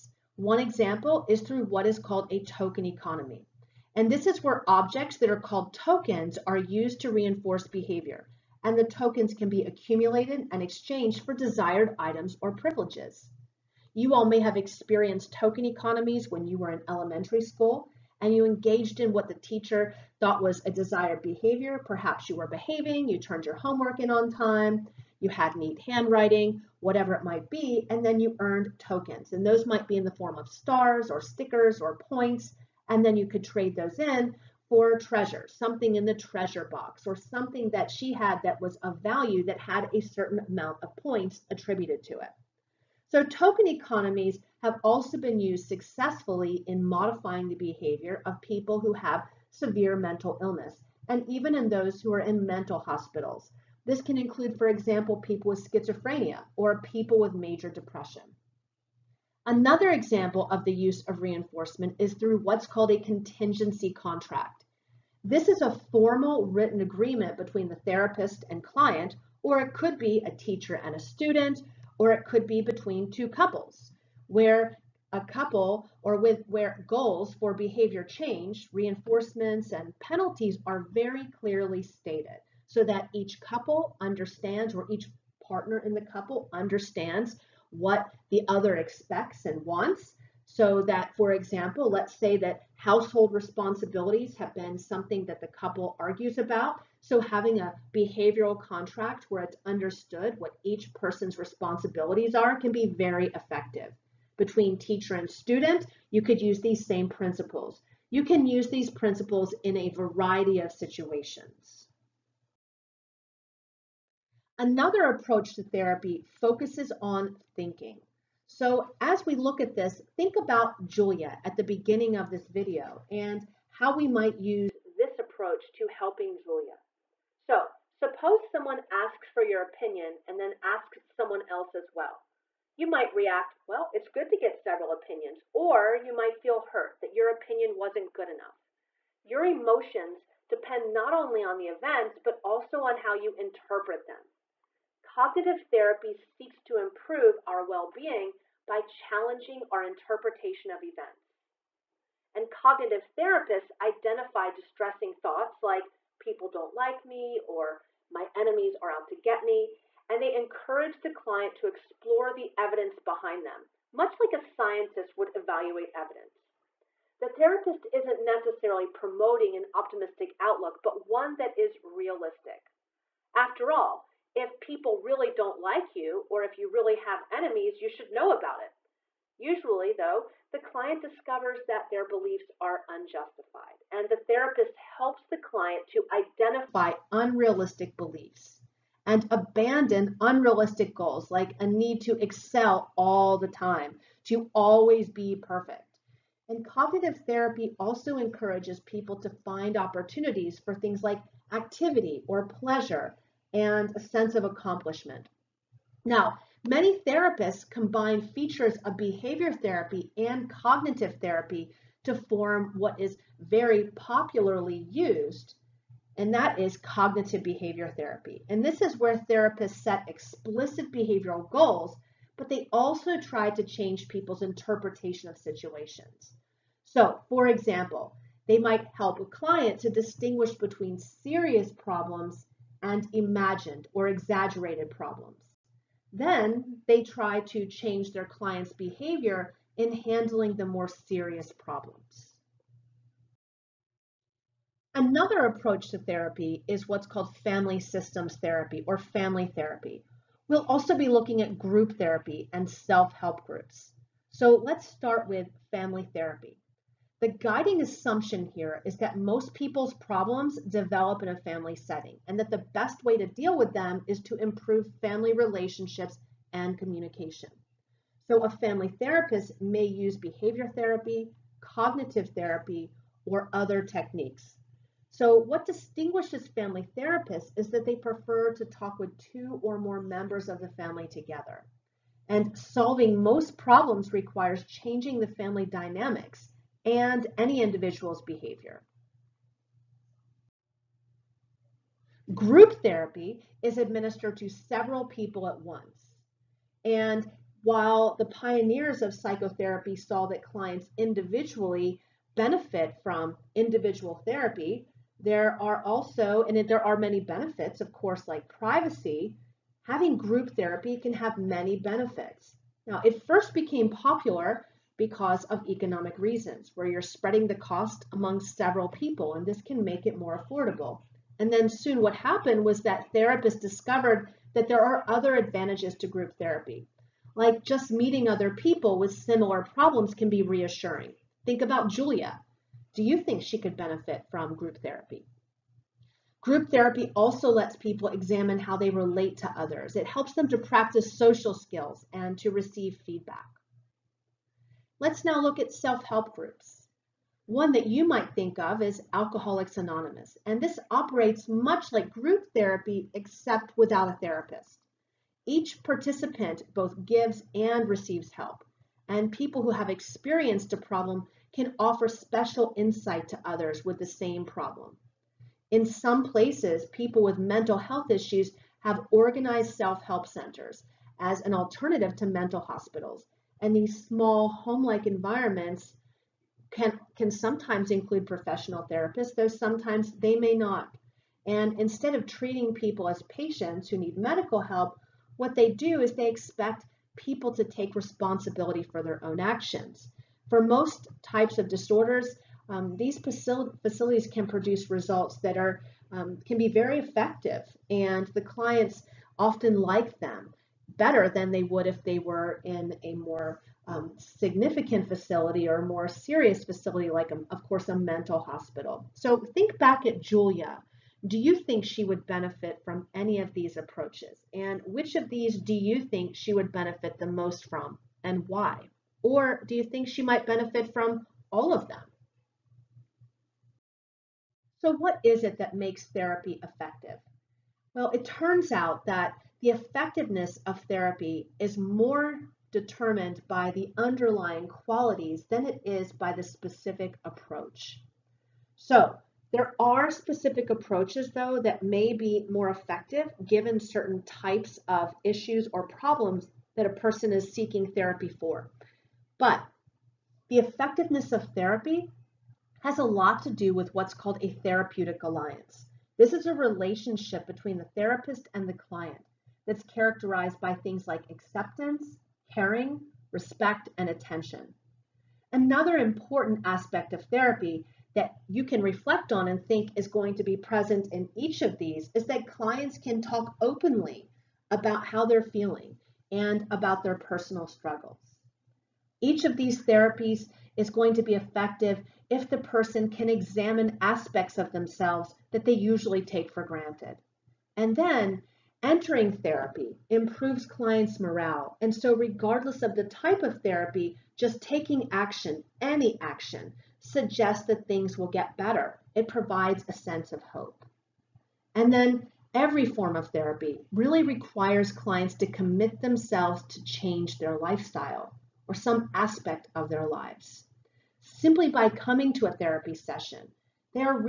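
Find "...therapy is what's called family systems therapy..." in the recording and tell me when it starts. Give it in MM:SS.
04:05.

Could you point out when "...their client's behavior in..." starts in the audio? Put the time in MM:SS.
03:58.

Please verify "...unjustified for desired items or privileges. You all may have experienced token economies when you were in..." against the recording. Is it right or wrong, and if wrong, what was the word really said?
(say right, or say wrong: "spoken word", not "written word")
wrong: "exchanged", not "unjustified".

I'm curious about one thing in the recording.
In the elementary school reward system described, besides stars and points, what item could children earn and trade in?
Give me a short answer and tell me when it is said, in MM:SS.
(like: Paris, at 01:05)
stickers, at 00:31.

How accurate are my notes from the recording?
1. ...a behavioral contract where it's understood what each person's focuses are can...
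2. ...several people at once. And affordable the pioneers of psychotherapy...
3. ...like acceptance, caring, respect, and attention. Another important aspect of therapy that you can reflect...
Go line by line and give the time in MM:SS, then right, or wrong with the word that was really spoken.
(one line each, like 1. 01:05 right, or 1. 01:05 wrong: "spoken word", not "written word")
1. 01:37 wrong: "responsibilities", not "focuses"
2. 04:54 wrong: "while", not "affordable"
3. 07:41 right.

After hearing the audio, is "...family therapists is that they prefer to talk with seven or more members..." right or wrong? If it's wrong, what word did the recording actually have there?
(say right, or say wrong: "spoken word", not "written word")
wrong: "two", not "seven".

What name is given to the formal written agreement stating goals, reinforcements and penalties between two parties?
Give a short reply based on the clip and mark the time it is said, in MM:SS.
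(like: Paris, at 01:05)
contingency contract, at 01:03.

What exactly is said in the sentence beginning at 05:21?
And then soon what happened was that therapists discovered that there are other advantages to group therapy.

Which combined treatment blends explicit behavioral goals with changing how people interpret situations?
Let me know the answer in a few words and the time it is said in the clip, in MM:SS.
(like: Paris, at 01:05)
cognitive behavior therapy, at 03:36.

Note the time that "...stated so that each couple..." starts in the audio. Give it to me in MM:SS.
01:21.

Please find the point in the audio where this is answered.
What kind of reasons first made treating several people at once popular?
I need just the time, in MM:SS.
05:15.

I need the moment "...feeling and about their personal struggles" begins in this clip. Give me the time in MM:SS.
07:55.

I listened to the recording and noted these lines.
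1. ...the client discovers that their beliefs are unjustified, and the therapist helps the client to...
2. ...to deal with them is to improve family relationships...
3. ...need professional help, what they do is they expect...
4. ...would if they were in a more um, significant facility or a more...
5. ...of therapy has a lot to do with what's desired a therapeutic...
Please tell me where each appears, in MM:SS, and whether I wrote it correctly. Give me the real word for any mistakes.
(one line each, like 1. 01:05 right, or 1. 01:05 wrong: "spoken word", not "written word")
1. 03:00 right
2. 04:23 right
3. 06:23 wrong: "medical", not "professional"
4. 06:41 right
5. 07:31 wrong: "called", not "desired".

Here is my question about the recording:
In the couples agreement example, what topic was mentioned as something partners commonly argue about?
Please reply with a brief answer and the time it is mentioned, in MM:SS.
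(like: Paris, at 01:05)
household responsibilities, at 01:32.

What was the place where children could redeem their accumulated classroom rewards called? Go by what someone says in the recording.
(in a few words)
treasure box.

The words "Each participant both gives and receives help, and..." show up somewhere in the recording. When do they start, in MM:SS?
05:55.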